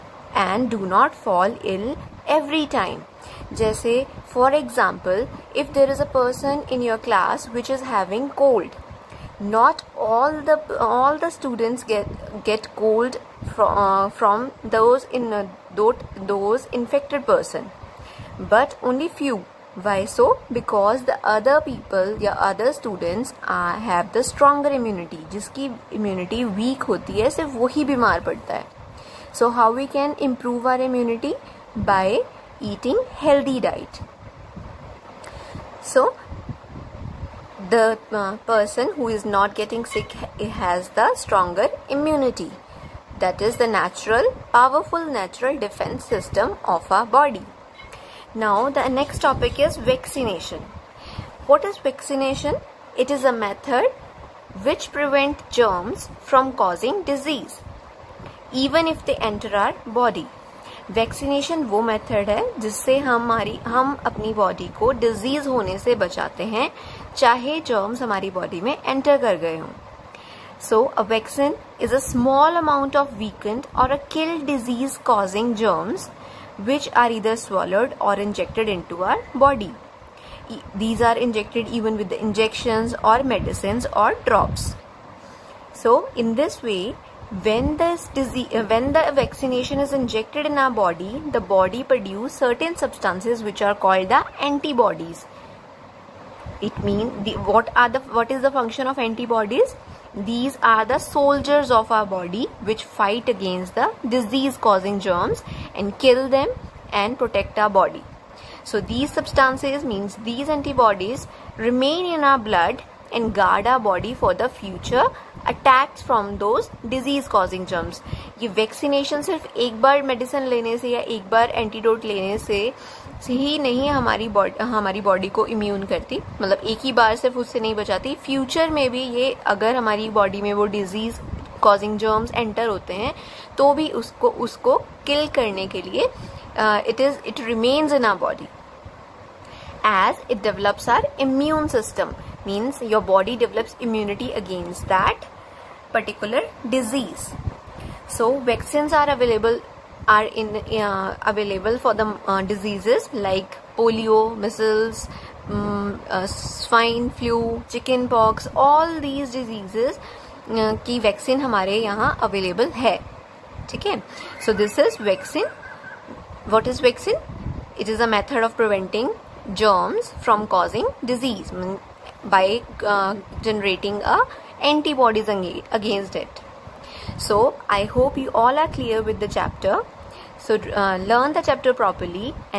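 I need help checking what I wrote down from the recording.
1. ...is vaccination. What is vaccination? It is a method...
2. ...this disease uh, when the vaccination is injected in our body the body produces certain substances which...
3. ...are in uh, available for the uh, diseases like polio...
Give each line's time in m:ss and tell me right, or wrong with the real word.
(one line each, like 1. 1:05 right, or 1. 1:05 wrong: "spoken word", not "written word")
1. 0:49 right
2. 1:27 right
3. 2:30 right.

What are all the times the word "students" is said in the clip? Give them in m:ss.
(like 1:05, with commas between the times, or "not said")
0:11, 0:22.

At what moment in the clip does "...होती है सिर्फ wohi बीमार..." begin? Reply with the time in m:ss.
0:26.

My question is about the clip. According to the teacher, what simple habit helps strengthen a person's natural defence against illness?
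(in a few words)
eating healthy diet.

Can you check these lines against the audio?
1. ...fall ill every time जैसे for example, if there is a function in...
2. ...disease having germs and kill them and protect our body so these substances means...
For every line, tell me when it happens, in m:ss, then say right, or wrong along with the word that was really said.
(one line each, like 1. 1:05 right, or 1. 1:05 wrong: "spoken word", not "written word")
1. 0:01 wrong: "person", not "function"
2. 1:44 wrong: "causing", not "having".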